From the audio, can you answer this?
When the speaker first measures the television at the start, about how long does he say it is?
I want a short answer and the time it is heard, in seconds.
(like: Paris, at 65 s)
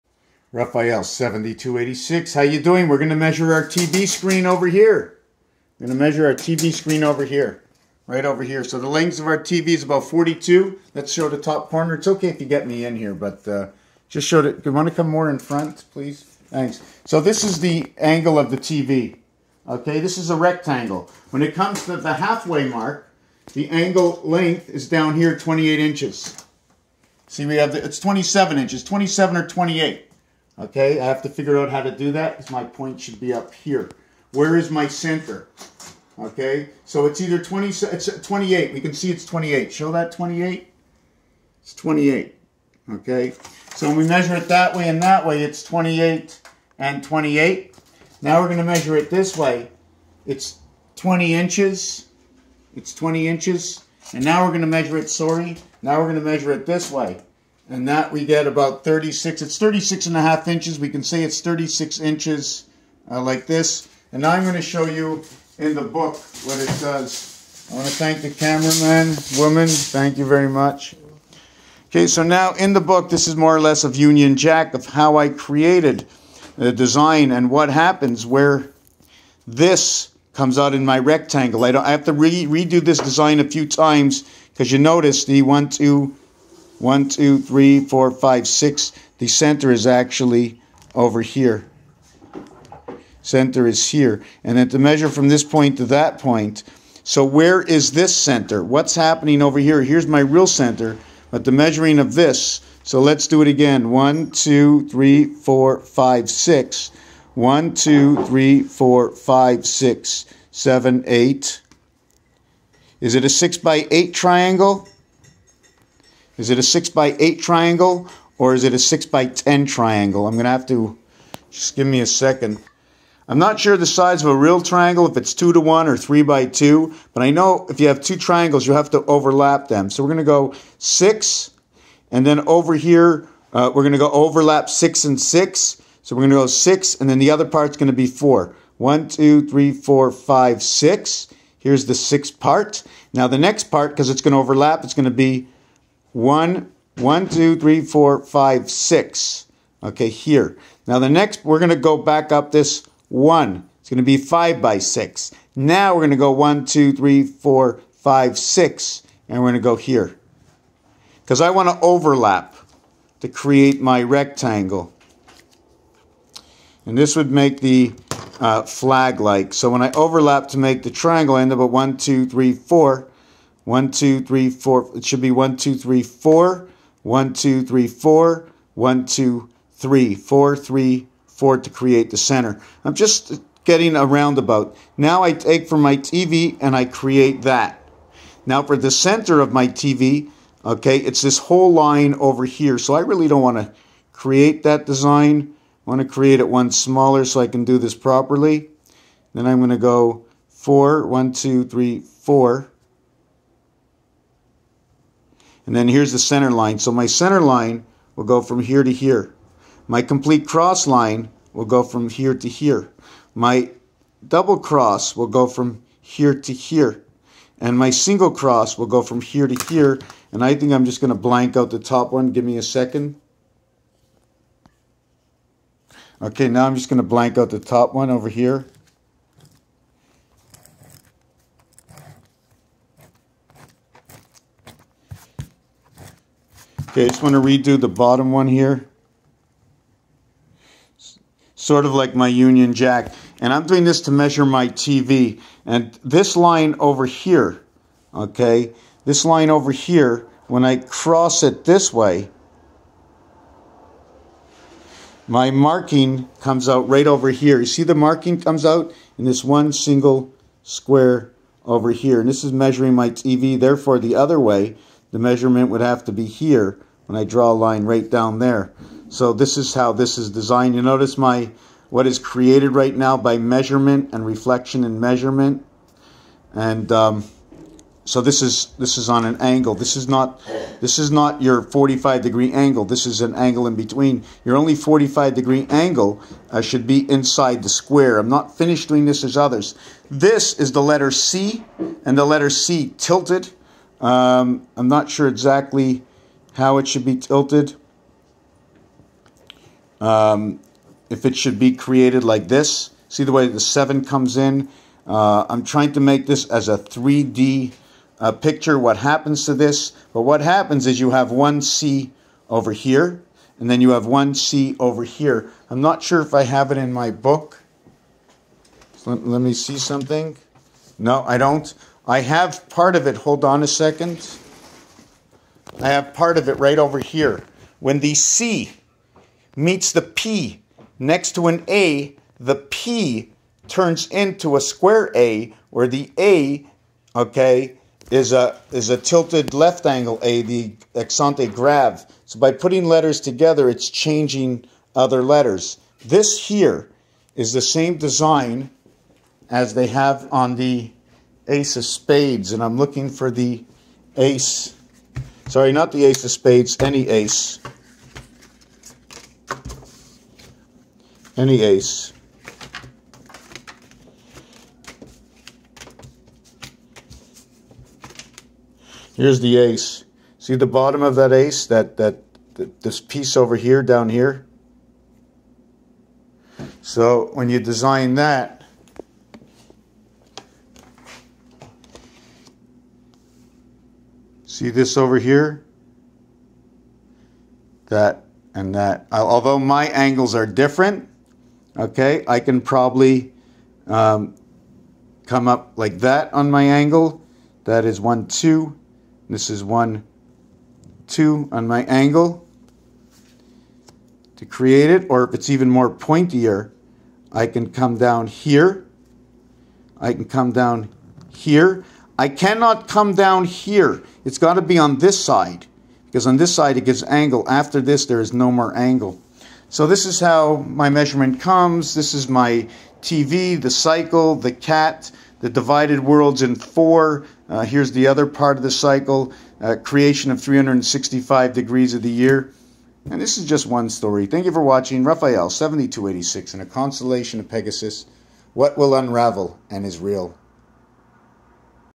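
42, at 9 s.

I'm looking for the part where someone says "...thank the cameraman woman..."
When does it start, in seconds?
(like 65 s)
67 s.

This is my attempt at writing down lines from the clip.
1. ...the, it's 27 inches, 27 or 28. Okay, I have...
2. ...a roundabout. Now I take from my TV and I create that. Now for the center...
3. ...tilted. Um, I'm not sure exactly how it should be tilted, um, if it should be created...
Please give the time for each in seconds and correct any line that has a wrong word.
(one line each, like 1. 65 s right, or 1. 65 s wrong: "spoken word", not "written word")
1. 27 s right
2. 183 s right
3. 292 s right.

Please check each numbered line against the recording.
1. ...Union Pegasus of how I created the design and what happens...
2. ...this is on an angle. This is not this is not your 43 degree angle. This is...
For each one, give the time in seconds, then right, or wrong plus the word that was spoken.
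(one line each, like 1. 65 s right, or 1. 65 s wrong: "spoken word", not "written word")
1. 73 s wrong: "Jack", not "Pegasus"
2. 278 s wrong: "45", not "43".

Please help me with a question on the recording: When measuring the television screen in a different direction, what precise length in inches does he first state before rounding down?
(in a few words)
36 and a half inches.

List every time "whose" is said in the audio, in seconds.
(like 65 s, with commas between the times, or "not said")
not said.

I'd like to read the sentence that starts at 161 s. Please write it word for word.
Because I want to overlap to create my rectangle.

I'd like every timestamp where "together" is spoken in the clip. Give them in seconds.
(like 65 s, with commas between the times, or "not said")
343 s.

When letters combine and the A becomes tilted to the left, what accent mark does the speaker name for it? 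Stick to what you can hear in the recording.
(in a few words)
accent grave.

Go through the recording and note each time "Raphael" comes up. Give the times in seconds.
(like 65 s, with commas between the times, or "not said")
0 s, 435 s.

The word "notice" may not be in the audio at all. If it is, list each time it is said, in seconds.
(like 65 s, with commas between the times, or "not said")
84 s, 270 s.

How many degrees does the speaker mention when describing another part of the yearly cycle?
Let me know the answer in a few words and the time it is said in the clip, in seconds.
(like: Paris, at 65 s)
365, at 430 s.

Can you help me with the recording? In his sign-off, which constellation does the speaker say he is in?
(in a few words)
Pegasus.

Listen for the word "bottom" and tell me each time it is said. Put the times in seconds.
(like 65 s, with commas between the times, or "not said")
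237 s, 370 s.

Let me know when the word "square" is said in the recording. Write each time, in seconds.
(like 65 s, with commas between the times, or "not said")
260 s, 287 s, 334 s.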